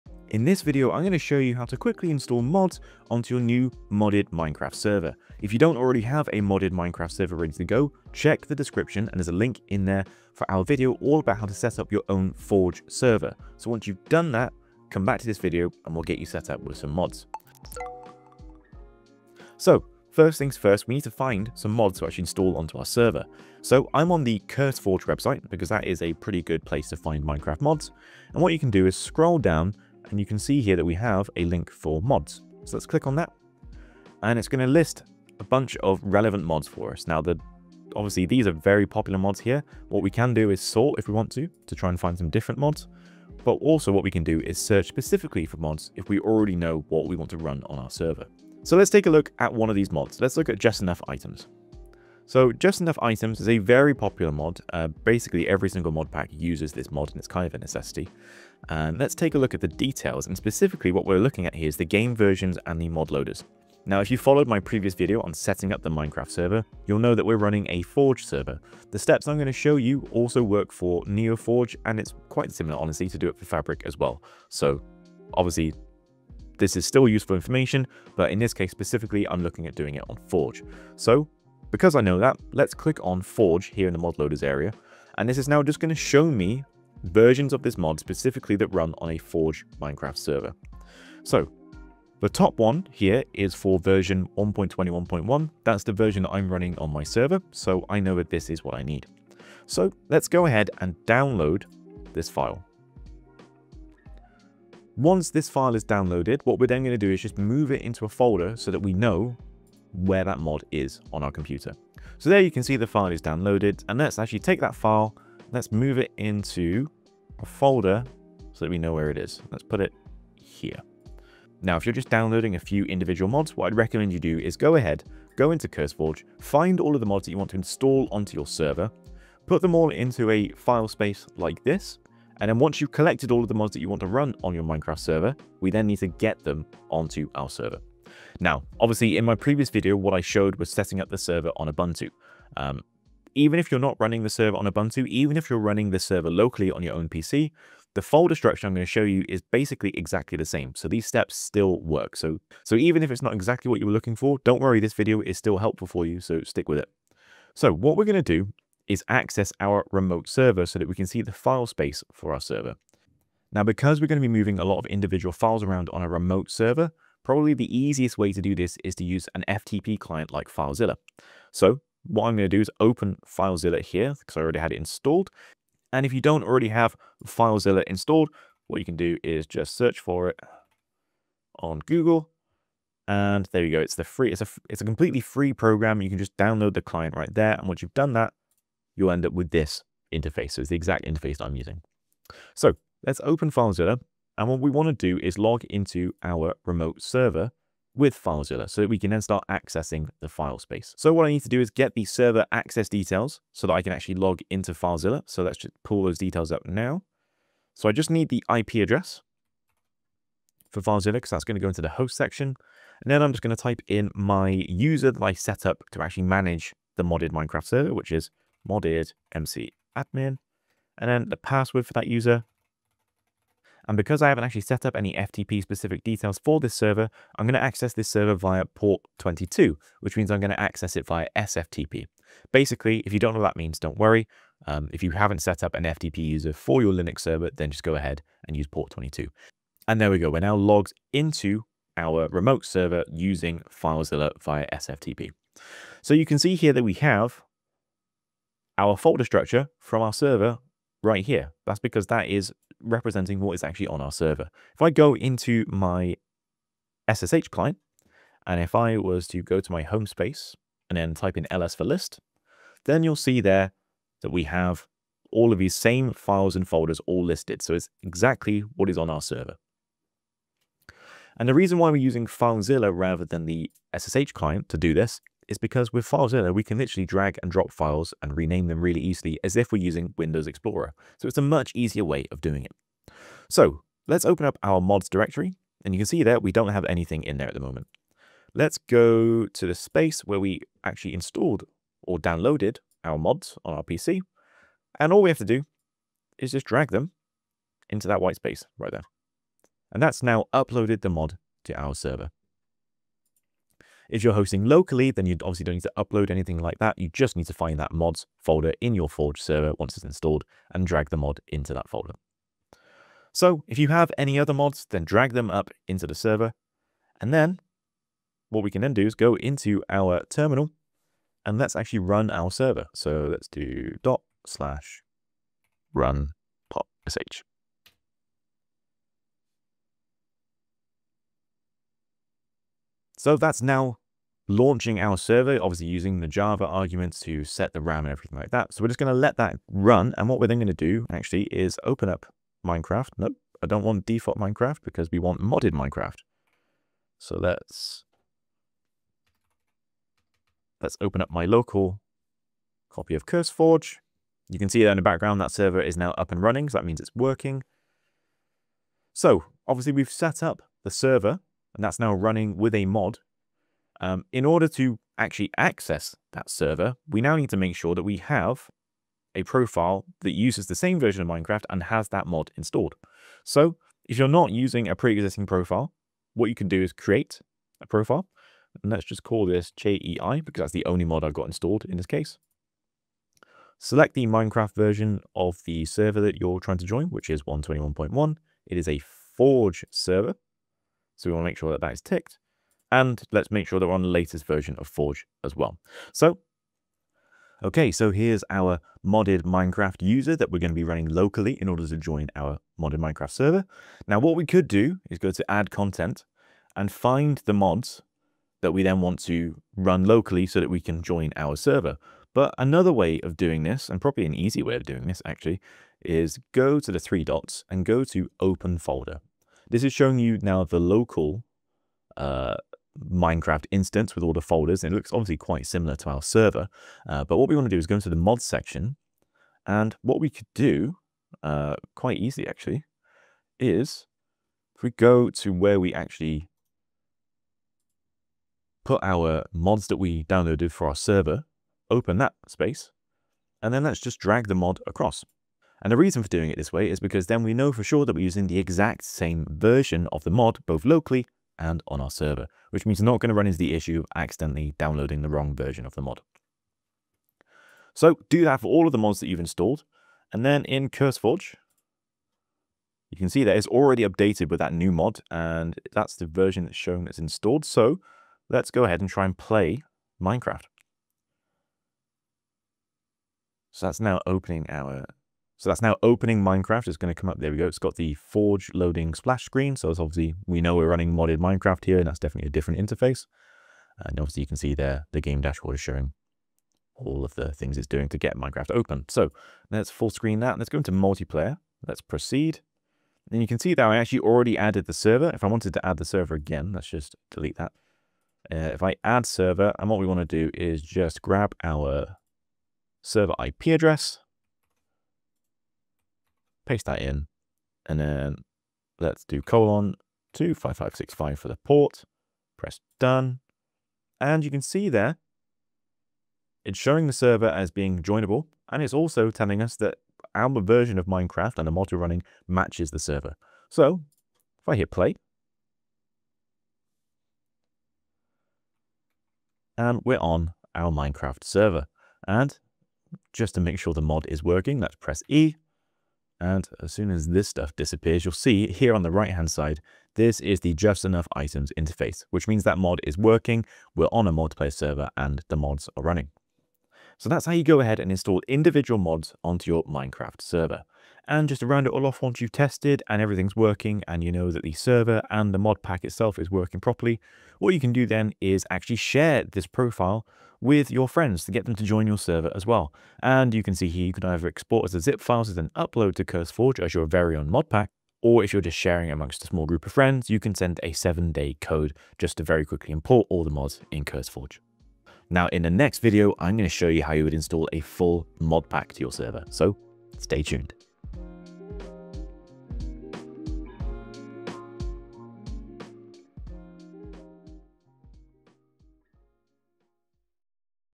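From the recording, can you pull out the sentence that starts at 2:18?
Now, obviously in my previous video, what I showed was setting up the server on Ubuntu.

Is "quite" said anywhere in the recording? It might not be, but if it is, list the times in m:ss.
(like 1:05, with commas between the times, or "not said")
1:12, 7:05, 7:11.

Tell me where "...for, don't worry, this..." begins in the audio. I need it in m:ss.
2:34.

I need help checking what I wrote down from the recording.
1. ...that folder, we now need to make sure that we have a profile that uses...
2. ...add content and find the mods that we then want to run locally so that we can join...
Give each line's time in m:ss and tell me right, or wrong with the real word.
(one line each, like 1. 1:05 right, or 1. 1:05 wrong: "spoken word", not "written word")
1. 6:06 wrong: "server", not "folder"
2. 6:45 right.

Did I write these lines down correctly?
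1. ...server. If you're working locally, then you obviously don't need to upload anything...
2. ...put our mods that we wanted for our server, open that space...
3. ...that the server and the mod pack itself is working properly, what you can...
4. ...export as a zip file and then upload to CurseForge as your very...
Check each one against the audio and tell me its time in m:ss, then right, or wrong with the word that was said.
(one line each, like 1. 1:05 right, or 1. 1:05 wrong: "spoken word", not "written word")
1. 5:01 wrong: "hosting", not "working"
2. 7:18 wrong: "downloaded", not "wanted"
3. 9:14 right
4. 9:24 right.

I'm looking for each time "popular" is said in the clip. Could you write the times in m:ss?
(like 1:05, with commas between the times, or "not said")
0:38, 0:53.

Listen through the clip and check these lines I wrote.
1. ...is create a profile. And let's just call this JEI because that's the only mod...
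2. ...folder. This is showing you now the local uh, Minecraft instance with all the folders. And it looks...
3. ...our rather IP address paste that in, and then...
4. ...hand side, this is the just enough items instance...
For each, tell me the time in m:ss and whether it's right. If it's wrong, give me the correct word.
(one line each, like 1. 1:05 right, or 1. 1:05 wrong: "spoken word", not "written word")
1. 6:16 right
2. 6:58 right
3. 8:21 wrong: "server", not "rather"
4. 8:59 wrong: "interface", not "instance".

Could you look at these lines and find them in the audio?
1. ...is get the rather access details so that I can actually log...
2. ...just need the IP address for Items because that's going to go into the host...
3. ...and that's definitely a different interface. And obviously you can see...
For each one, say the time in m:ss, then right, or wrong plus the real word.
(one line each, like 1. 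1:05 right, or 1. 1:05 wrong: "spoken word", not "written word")
1. 3:21 wrong: "server", not "rather"
2. 3:27 wrong: "FileZilla", not "Items"
3. 8:01 right.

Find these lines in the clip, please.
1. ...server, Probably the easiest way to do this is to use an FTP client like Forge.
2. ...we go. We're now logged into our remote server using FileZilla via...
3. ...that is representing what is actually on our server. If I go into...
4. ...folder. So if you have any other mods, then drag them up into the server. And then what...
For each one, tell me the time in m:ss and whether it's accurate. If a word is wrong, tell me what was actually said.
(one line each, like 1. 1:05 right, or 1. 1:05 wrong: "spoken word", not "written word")
1. 2:46 wrong: "FileZilla", not "Forge"
2. 4:00 right
3. 4:12 right
4. 5:11 right.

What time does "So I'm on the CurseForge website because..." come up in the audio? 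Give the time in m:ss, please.
0:23.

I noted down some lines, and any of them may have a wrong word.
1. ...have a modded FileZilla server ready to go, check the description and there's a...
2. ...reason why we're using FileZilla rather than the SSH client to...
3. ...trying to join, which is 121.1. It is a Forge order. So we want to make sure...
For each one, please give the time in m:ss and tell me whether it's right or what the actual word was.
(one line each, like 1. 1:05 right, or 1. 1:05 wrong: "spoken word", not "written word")
1. 0:06 wrong: "Minecraft", not "FileZilla"
2. 4:31 right
3. 6:26 wrong: "server", not "order".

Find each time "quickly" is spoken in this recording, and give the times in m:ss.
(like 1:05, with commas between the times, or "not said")
0:01, 9:32.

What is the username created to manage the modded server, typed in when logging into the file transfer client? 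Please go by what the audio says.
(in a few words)
modded mc admin.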